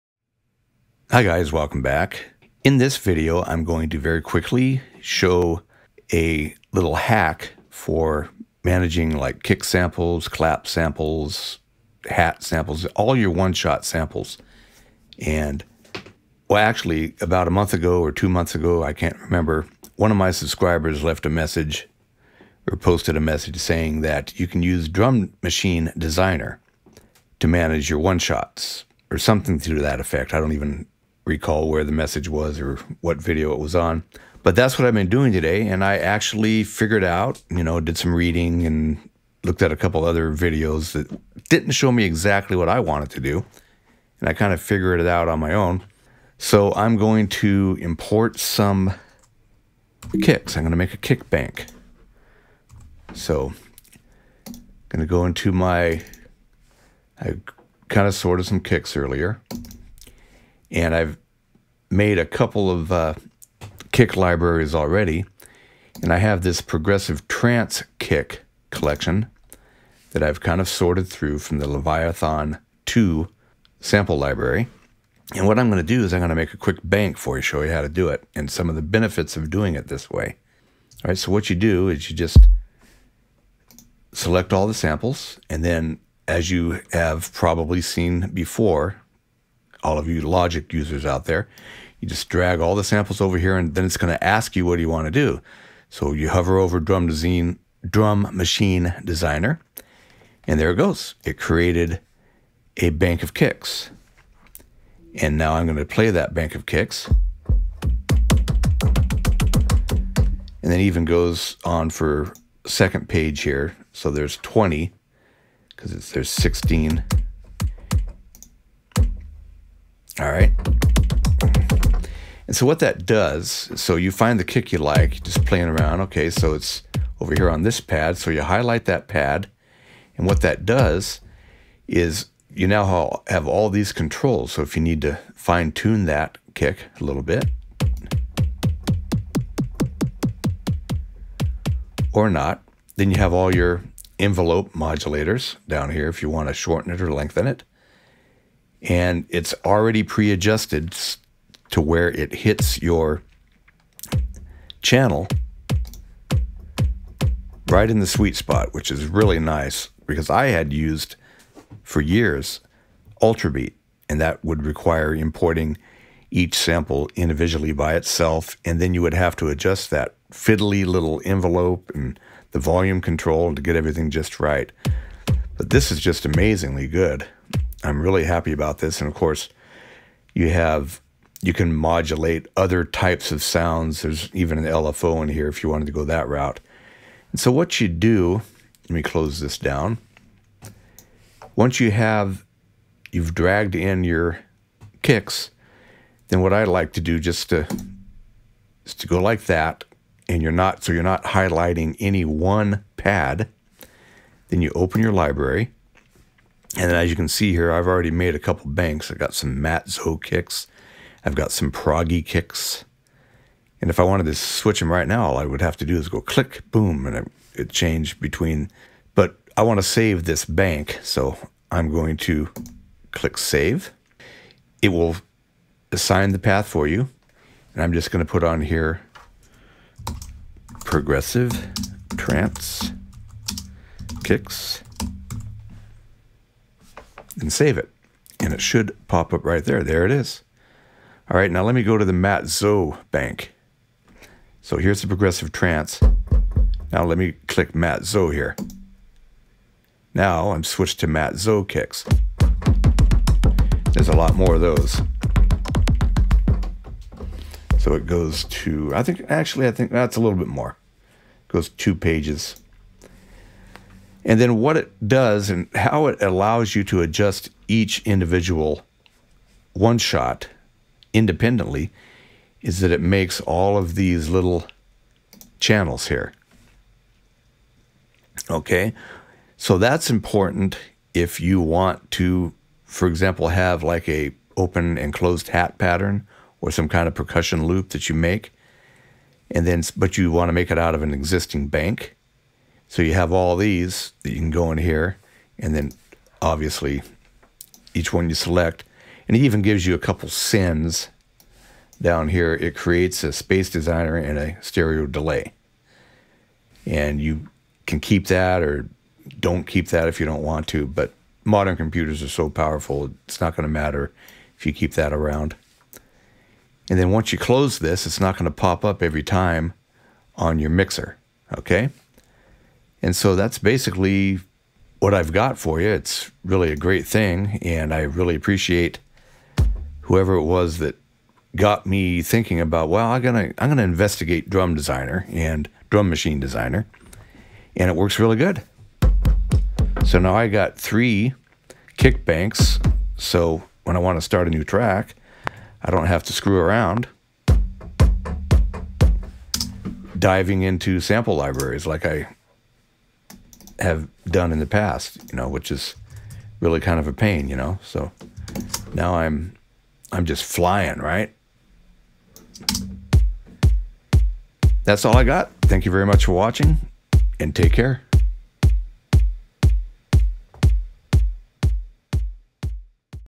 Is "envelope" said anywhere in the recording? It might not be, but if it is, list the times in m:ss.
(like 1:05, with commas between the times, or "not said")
2:24, 2:51.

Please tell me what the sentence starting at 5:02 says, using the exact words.
It creates a space designer and a stereo delay.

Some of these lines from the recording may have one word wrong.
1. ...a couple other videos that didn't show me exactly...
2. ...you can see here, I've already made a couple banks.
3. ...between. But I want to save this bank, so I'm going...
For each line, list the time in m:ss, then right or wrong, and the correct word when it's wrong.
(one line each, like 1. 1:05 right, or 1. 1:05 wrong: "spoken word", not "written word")
1. 0:39 right
2. 3:27 right
3. 3:38 right.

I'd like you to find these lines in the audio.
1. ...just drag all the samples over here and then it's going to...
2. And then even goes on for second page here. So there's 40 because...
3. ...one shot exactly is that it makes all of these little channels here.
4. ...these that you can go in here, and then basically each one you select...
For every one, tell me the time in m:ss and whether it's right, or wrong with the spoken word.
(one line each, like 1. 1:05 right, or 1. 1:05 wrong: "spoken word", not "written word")
1. 1:32 right
2. 1:50 wrong: "20", not "40"
3. 4:29 wrong: "independently", not "exactly"
4. 4:53 wrong: "obviously", not "basically".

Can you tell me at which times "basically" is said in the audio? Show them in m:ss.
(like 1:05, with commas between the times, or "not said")
5:23.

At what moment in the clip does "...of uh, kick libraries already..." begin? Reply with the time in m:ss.
1:02.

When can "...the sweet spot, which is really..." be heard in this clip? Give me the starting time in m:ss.
2:37.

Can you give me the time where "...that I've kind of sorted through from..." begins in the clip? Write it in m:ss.
1:10.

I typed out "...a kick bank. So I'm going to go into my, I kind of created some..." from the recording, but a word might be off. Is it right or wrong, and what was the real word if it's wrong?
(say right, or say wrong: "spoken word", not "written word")
wrong: "sorted", not "created".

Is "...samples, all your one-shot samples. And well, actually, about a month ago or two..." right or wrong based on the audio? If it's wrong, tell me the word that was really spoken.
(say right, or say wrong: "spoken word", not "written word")
right.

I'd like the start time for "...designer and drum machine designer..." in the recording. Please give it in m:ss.
5:34.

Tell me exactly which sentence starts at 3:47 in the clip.
And I'm just going to put on here progressive trance kicks and save it.